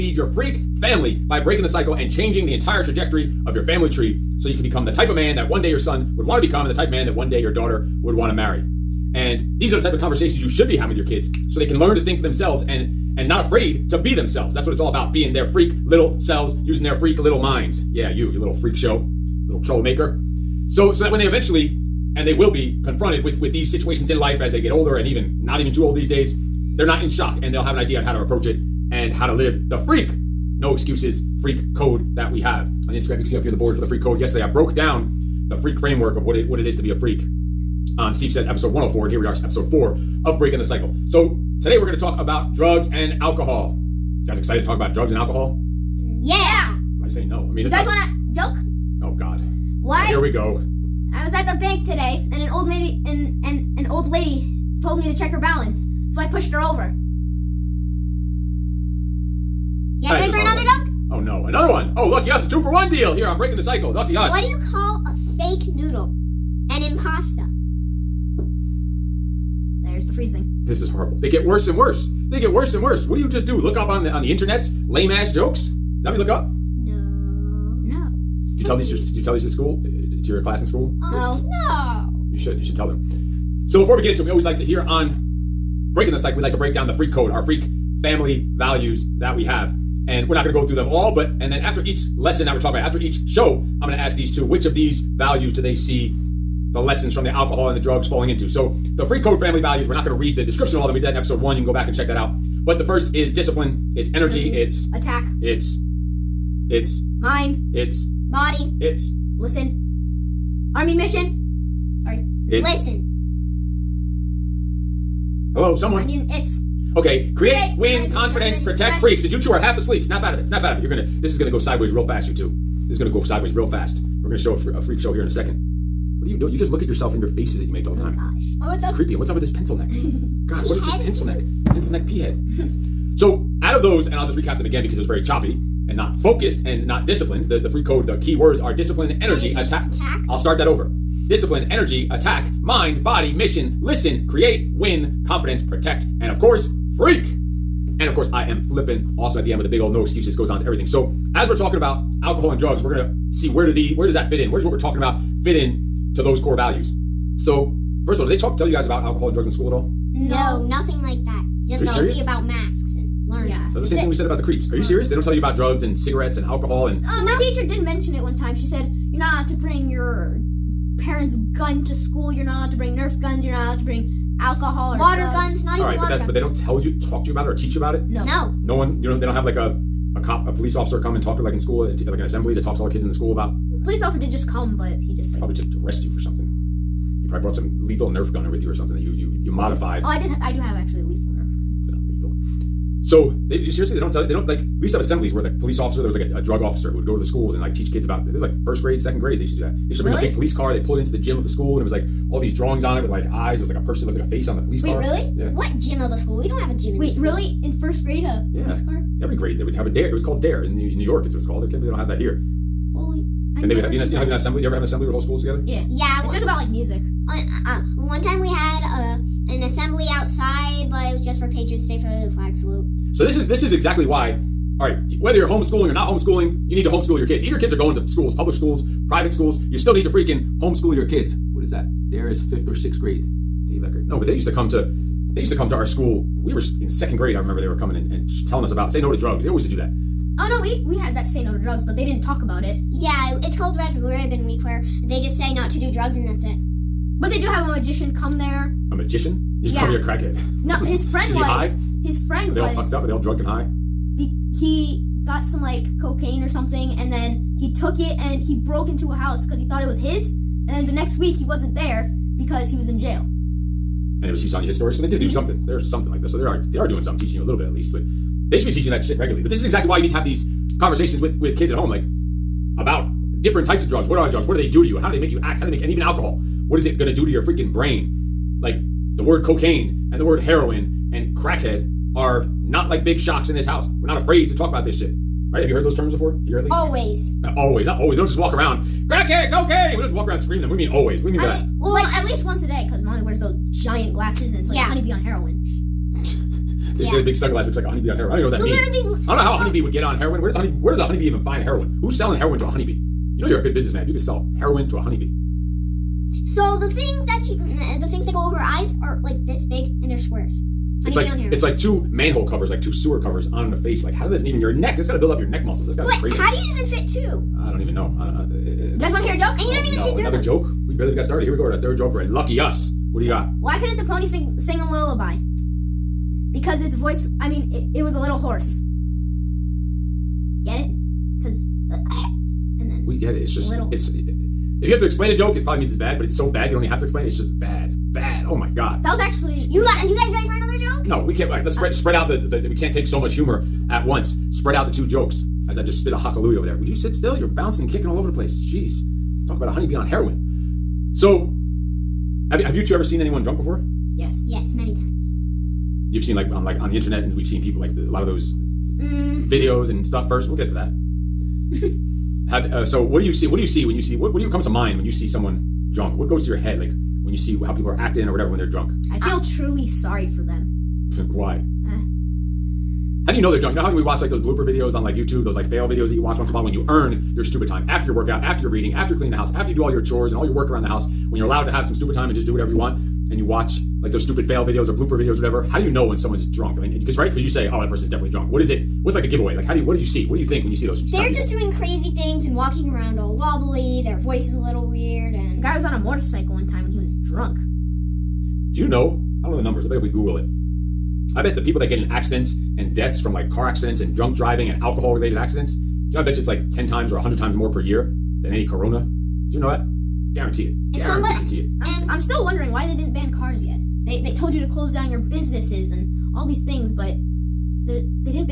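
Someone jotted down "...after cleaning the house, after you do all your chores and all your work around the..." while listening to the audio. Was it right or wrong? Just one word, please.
right.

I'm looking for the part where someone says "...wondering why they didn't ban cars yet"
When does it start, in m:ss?
6:52.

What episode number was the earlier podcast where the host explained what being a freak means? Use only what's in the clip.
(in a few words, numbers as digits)
104.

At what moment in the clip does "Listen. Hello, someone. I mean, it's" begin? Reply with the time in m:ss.
1:52.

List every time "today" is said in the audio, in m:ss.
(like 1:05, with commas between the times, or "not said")
0:41, 0:51.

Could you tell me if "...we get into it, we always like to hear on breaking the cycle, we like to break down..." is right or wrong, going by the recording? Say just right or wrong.
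right.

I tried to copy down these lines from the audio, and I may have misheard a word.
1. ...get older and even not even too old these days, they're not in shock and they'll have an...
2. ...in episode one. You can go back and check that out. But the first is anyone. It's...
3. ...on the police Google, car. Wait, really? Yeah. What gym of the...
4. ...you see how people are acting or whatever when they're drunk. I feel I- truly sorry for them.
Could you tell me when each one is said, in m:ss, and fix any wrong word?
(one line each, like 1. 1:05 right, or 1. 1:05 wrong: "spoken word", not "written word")
1. 0:24 right
2. 1:41 wrong: "discipline", not "anyone"
3. 3:24 wrong: "Wait", not "Google"
4. 6:07 right.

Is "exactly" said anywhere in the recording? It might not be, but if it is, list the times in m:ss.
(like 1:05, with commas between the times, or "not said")
3:43, 4:29.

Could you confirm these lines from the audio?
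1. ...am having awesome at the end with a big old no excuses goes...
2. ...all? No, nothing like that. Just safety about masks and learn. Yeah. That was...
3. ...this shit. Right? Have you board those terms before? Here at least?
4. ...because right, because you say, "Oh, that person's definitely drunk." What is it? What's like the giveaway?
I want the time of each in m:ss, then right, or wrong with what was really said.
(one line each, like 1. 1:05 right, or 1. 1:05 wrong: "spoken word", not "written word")
1. 2:28 wrong: "flipping", not "having"
2. 2:39 right
3. 4:44 wrong: "heard", not "board"
4. 6:26 right.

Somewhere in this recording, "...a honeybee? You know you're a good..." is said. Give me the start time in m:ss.
5:02.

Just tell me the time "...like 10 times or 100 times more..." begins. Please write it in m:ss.
6:46.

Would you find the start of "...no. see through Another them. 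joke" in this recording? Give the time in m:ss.
5:20.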